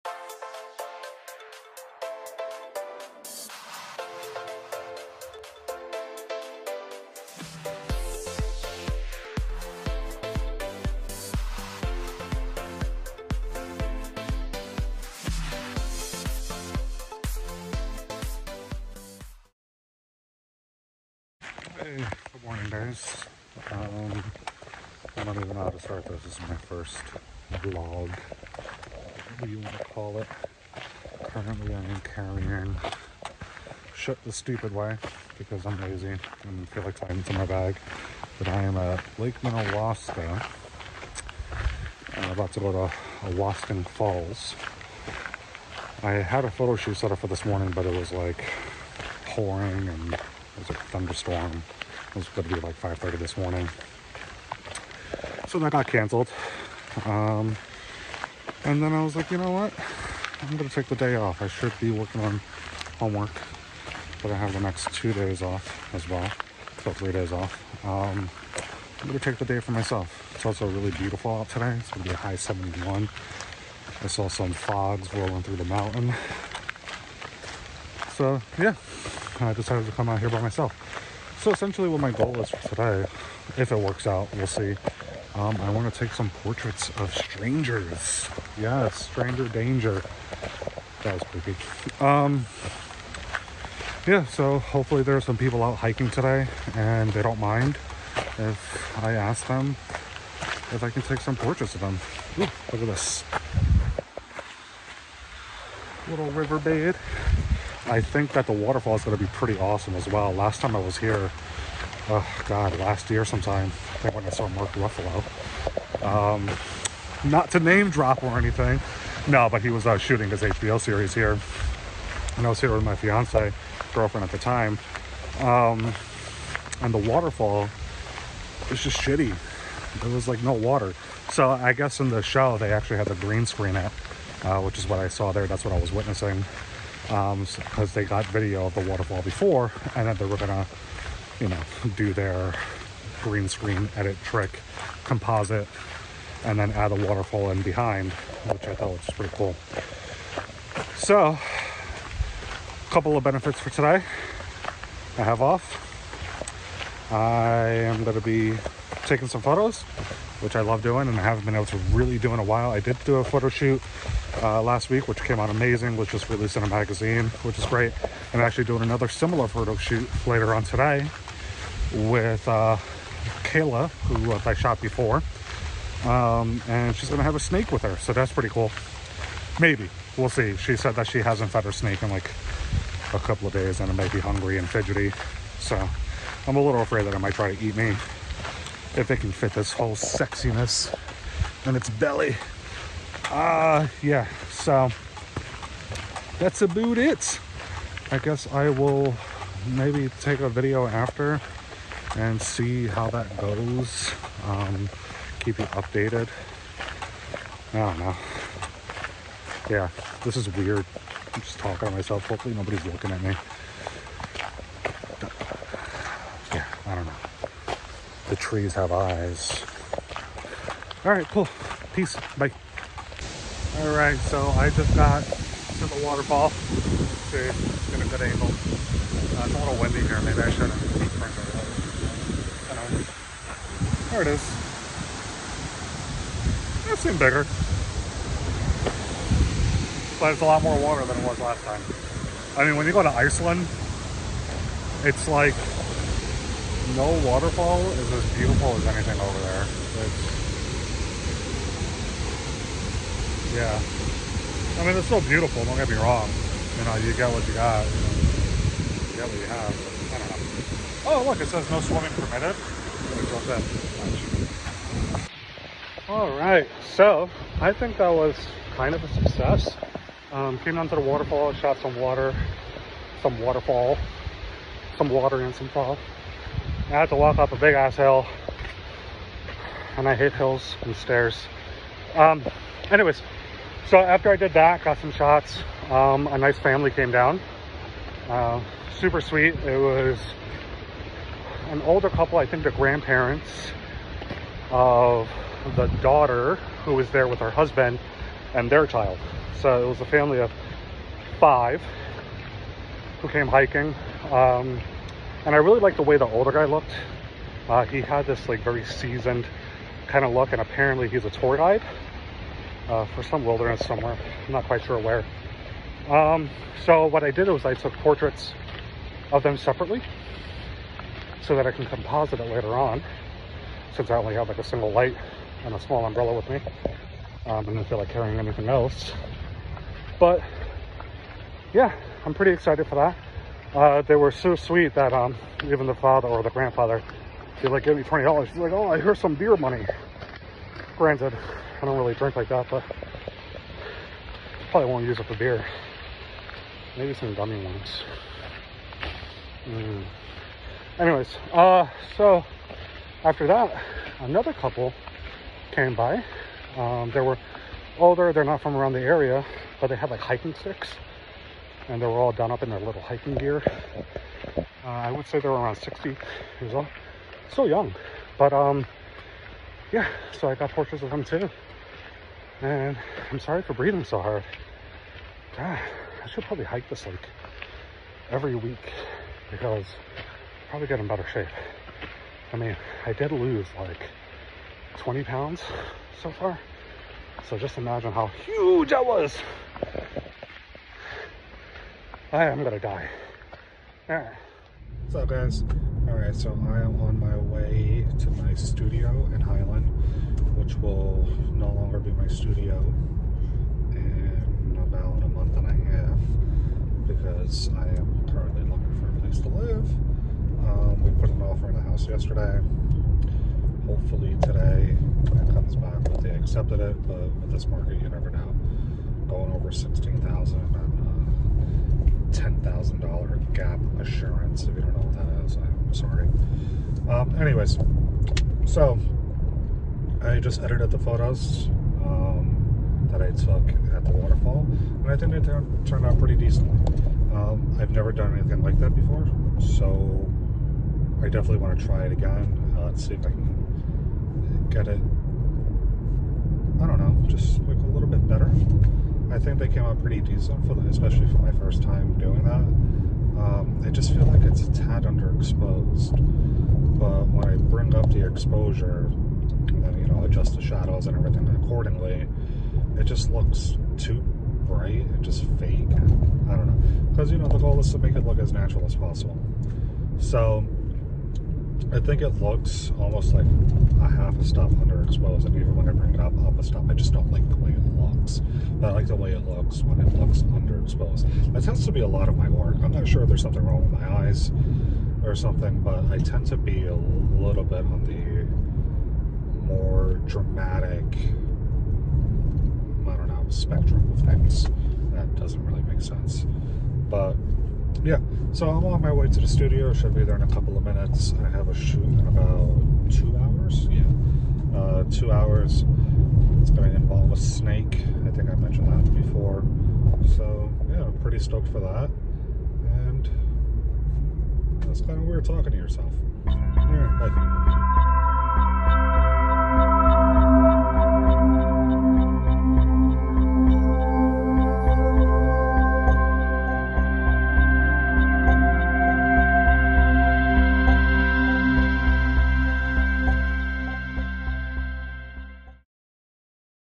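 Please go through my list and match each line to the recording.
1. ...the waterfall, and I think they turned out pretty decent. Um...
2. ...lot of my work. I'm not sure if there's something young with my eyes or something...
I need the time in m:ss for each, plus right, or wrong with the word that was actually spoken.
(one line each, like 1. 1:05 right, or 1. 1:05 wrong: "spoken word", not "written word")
1. 7:14 right
2. 8:02 wrong: "wrong", not "young".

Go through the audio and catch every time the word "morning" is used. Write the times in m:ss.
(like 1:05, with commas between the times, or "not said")
0:22, 0:47, 0:53.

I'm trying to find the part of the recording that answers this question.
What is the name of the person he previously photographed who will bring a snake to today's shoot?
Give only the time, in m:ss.
2:53.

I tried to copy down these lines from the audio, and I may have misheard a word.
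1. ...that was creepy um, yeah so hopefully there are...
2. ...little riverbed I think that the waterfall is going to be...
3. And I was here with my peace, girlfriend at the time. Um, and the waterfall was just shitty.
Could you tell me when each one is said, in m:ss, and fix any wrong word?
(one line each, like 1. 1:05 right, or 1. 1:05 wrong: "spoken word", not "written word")
1. 1:31 right
2. 1:46 right
3. 2:02 wrong: "fiance", not "peace".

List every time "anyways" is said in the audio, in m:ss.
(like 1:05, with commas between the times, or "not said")
4:42, 5:50, 7:07.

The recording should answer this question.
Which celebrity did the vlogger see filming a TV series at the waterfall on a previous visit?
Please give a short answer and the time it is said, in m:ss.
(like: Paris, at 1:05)
Mark Ruffalo, at 1:54.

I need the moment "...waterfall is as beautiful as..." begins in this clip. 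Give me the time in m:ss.
4:07.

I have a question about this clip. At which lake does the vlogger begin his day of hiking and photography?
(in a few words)
Lake Minnewaska.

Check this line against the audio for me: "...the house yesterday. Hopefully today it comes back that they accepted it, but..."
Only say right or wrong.
right.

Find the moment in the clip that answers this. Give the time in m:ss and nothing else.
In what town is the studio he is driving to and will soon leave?
6:39.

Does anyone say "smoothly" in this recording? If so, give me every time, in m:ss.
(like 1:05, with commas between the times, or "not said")
not said.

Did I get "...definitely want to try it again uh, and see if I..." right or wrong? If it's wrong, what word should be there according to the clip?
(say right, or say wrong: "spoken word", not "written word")
right.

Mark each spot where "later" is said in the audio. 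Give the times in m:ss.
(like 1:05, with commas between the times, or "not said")
2:50, 5:22.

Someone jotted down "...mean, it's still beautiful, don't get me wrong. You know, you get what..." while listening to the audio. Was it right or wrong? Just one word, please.
right.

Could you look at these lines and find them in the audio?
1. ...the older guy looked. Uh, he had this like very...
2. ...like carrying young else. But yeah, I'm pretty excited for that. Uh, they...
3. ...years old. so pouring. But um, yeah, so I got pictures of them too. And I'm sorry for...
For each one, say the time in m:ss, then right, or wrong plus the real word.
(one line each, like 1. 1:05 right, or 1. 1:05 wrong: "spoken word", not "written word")
1. 5:06 right
2. 5:27 wrong: "anything", not "young"
3. 6:06 wrong: "young", not "pouring".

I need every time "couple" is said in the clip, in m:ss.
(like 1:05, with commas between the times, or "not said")
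2:32, 3:03, 4:52, 5:54, 8:20.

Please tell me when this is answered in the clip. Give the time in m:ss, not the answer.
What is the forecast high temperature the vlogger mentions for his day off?
1:12.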